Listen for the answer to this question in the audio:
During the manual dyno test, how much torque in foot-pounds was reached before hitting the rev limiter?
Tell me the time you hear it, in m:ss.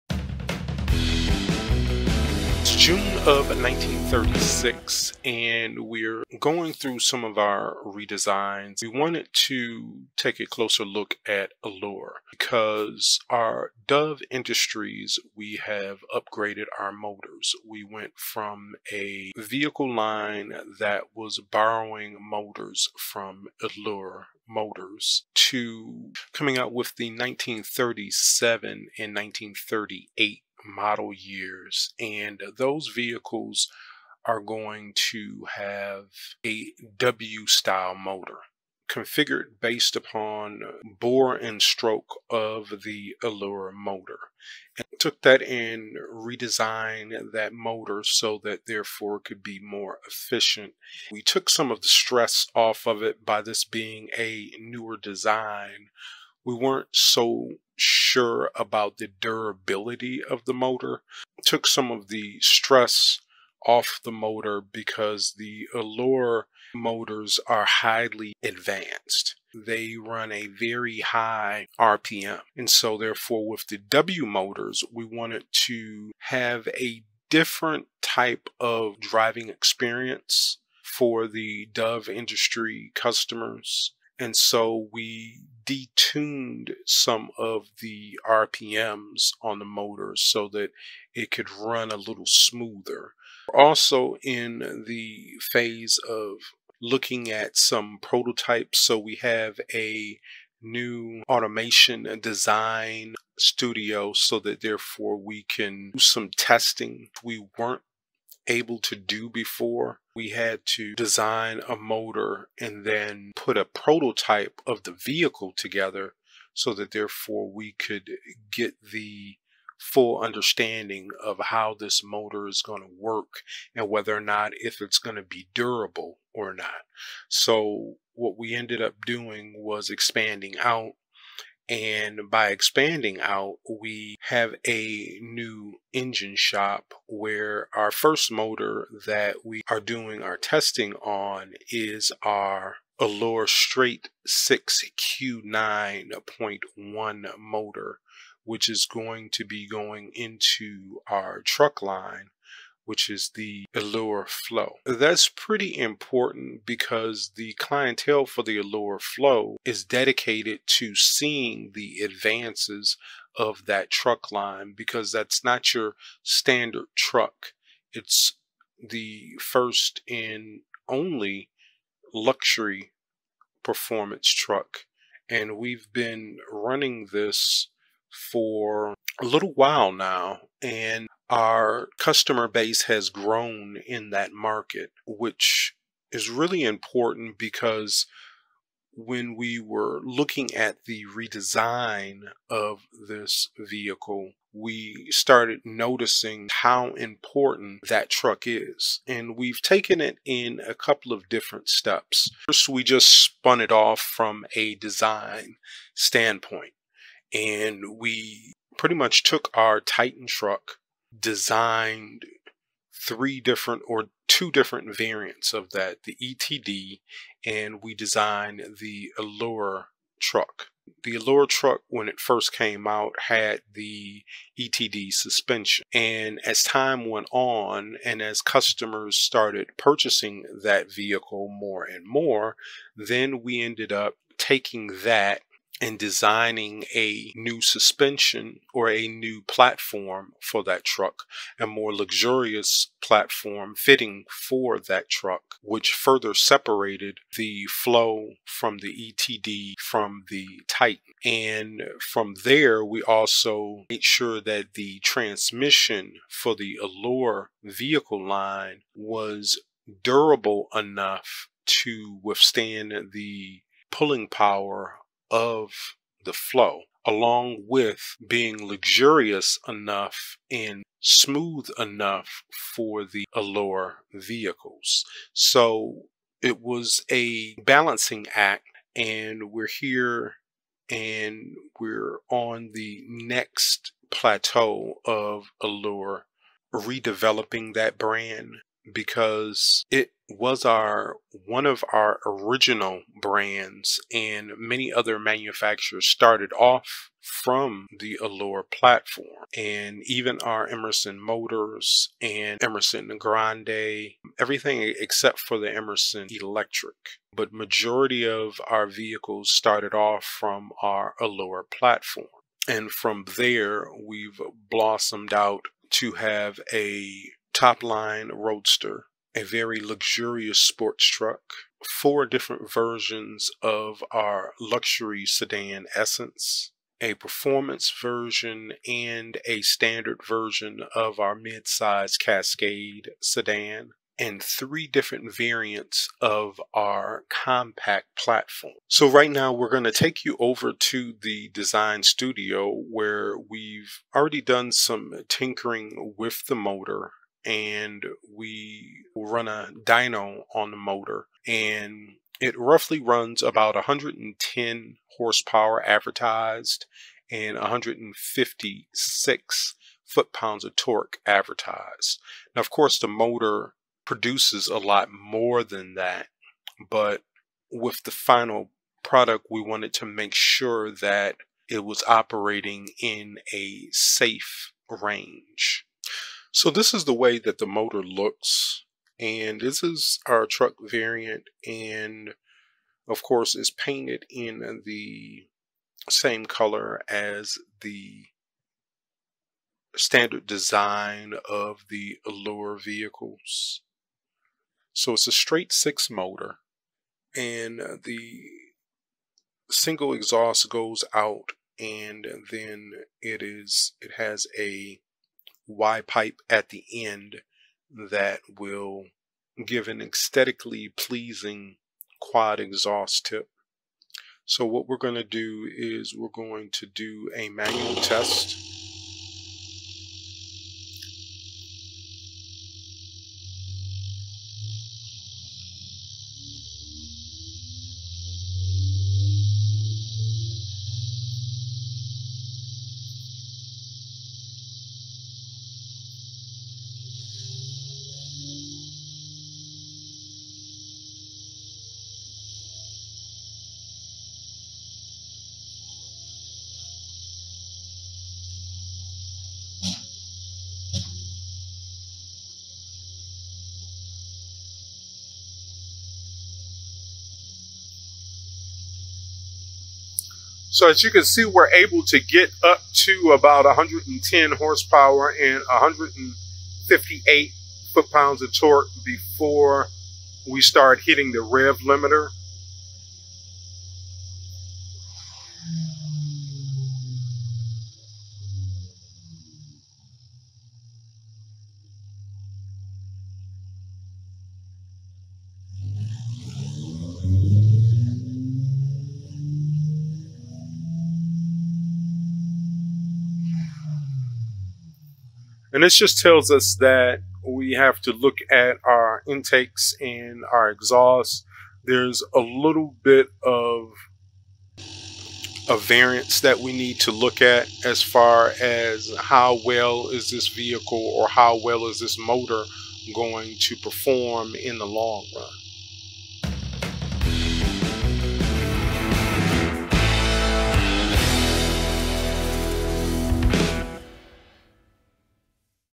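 7:45.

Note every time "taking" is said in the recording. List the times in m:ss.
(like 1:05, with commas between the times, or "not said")
3:54.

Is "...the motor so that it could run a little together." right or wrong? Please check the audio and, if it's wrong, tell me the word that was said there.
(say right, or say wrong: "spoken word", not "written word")
wrong: "smoother", not "together".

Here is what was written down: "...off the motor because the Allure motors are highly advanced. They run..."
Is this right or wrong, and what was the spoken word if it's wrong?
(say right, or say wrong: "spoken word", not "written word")
right.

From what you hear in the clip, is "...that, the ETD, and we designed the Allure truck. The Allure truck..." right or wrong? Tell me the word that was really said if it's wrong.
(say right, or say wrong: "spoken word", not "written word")
right.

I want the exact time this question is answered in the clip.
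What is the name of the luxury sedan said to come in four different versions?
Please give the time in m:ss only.
5:25.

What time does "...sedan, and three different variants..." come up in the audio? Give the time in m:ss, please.
5:33.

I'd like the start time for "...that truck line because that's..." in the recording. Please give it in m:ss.
2:43.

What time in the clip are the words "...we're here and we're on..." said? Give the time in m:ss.
4:39.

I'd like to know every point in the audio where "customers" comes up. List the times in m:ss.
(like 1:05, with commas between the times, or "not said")
1:22, 3:01, 3:48.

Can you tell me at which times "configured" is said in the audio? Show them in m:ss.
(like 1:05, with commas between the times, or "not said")
0:38.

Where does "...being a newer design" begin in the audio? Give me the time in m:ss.
0:53.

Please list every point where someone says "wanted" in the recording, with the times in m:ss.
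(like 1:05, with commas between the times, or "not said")
0:08, 1:15, 6:09.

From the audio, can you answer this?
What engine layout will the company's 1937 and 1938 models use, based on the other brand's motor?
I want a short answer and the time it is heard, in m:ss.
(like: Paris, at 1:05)
W style motor, at 0:36.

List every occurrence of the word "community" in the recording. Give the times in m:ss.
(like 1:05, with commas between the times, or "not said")
not said.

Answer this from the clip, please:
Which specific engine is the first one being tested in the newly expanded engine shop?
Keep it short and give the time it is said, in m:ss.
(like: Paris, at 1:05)
Allure Straight 6Q9.1, at 2:22.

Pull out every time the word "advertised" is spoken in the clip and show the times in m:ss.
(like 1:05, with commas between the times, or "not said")
5:55, 6:01.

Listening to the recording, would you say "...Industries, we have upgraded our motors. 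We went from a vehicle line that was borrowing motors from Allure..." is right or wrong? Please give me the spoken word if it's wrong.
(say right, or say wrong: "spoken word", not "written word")
right.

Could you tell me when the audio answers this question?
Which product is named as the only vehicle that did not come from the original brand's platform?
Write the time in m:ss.
5:05.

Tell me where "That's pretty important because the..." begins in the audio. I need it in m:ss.
2:34.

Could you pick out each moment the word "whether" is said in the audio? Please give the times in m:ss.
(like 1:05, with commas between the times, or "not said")
2:03.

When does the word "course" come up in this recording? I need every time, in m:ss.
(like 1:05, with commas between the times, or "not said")
6:02, 6:23.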